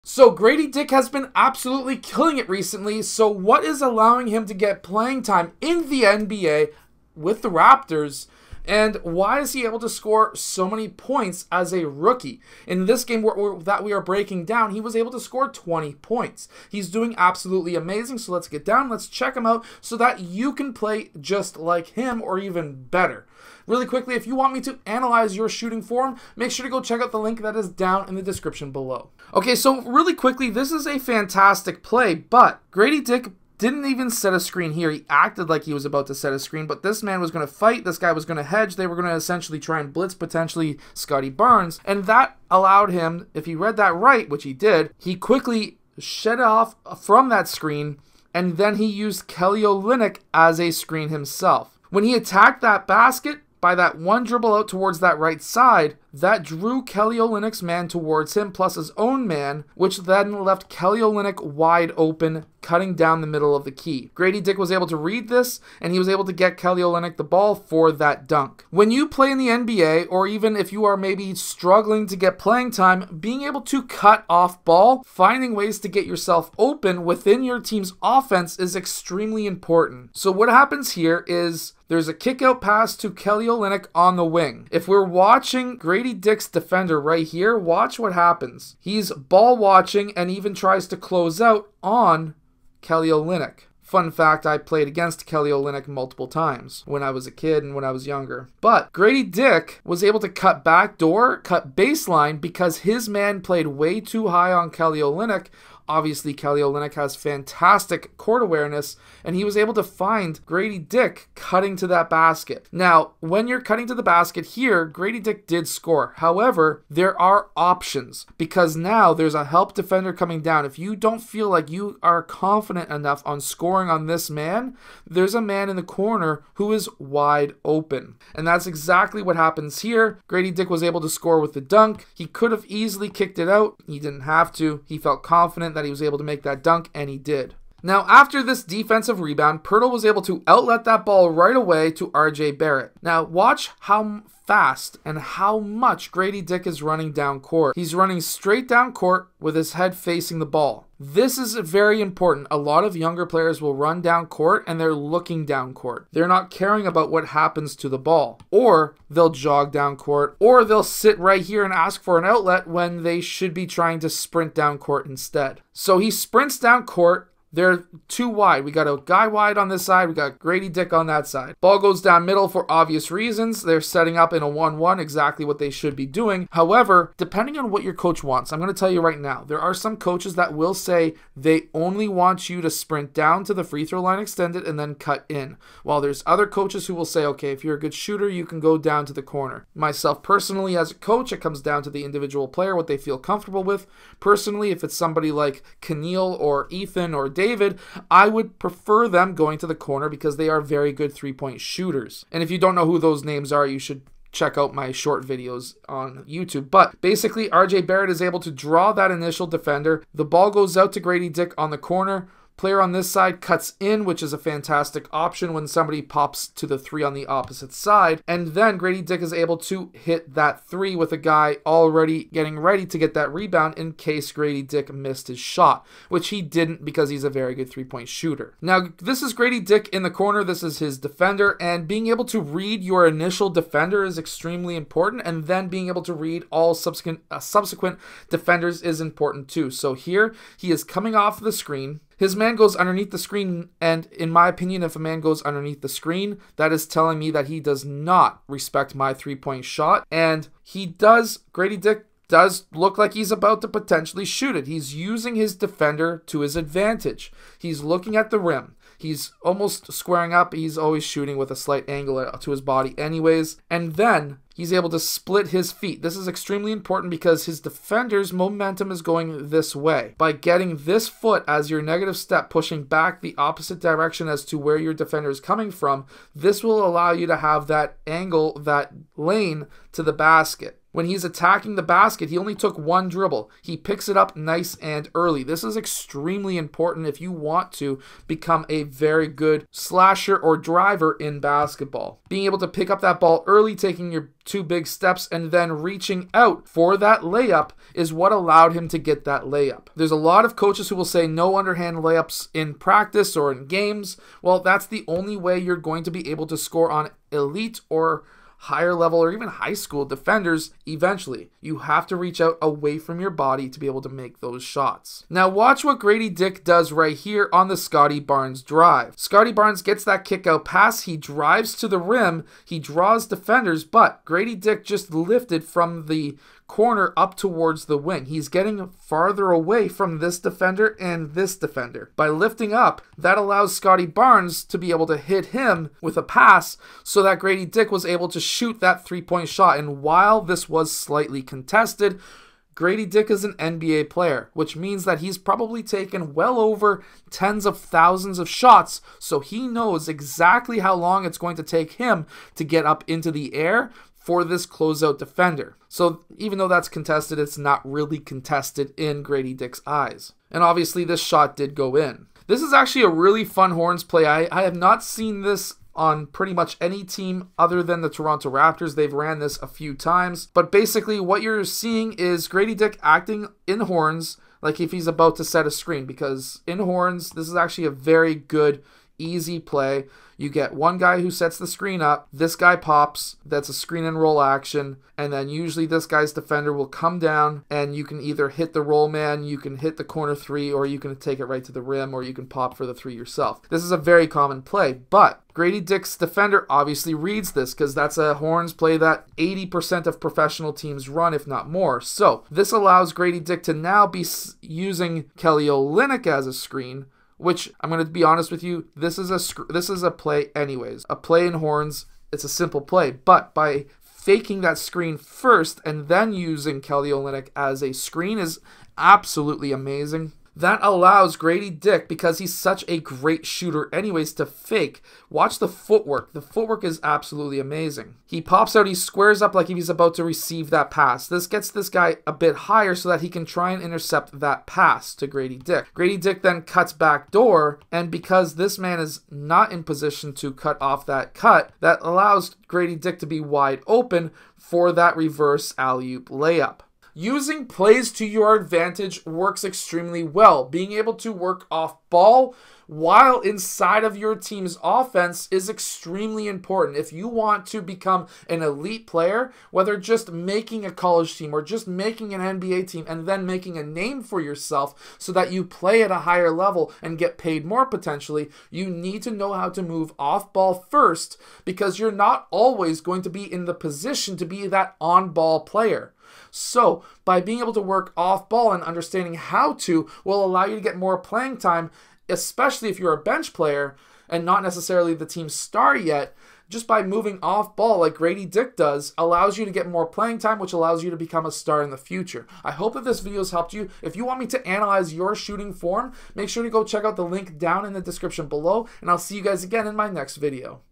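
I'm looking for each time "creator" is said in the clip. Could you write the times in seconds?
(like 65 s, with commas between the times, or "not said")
not said.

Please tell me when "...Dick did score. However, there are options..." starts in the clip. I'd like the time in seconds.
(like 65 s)
115 s.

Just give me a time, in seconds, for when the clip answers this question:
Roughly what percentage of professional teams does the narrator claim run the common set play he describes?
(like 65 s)
399 s.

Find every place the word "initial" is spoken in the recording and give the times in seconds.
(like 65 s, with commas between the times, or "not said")
209 s, 233 s.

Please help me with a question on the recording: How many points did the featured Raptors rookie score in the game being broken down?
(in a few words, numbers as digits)
20.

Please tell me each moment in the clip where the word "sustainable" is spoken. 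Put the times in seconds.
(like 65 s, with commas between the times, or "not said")
not said.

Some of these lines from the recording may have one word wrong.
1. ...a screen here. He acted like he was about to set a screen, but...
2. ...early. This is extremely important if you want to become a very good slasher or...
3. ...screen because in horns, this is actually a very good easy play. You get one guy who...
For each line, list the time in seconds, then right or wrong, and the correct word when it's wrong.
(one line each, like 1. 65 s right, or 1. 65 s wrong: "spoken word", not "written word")
1. 34 s right
2. 285 s right
3. 375 s right.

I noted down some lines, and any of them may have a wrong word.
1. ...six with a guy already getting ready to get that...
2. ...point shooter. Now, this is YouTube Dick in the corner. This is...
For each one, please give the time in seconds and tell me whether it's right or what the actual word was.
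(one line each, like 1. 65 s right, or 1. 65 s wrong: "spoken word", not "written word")
1. 220 s wrong: "three", not "six"
2. 227 s wrong: "Gradey", not "YouTube".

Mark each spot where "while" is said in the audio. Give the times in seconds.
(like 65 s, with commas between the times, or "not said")
185 s, 340 s, 452 s.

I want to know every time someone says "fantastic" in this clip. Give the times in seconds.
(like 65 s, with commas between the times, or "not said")
30 s, 107 s, 214 s.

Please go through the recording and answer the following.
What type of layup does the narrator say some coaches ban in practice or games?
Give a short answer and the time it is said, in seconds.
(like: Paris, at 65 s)
underhand layups, at 301 s.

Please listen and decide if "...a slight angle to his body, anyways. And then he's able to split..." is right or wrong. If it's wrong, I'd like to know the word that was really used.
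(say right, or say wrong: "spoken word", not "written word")
right.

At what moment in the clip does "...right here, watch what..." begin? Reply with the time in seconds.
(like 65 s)
87 s.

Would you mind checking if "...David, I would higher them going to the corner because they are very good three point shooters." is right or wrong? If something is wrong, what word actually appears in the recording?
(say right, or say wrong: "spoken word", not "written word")
wrong: "prefer", not "higher".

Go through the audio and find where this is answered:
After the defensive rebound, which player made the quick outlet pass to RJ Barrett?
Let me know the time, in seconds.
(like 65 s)
139 s.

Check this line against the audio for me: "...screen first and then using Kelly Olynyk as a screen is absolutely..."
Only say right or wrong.
right.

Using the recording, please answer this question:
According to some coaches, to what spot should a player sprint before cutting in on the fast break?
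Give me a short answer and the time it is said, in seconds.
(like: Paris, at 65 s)
free throw line extended, at 183 s.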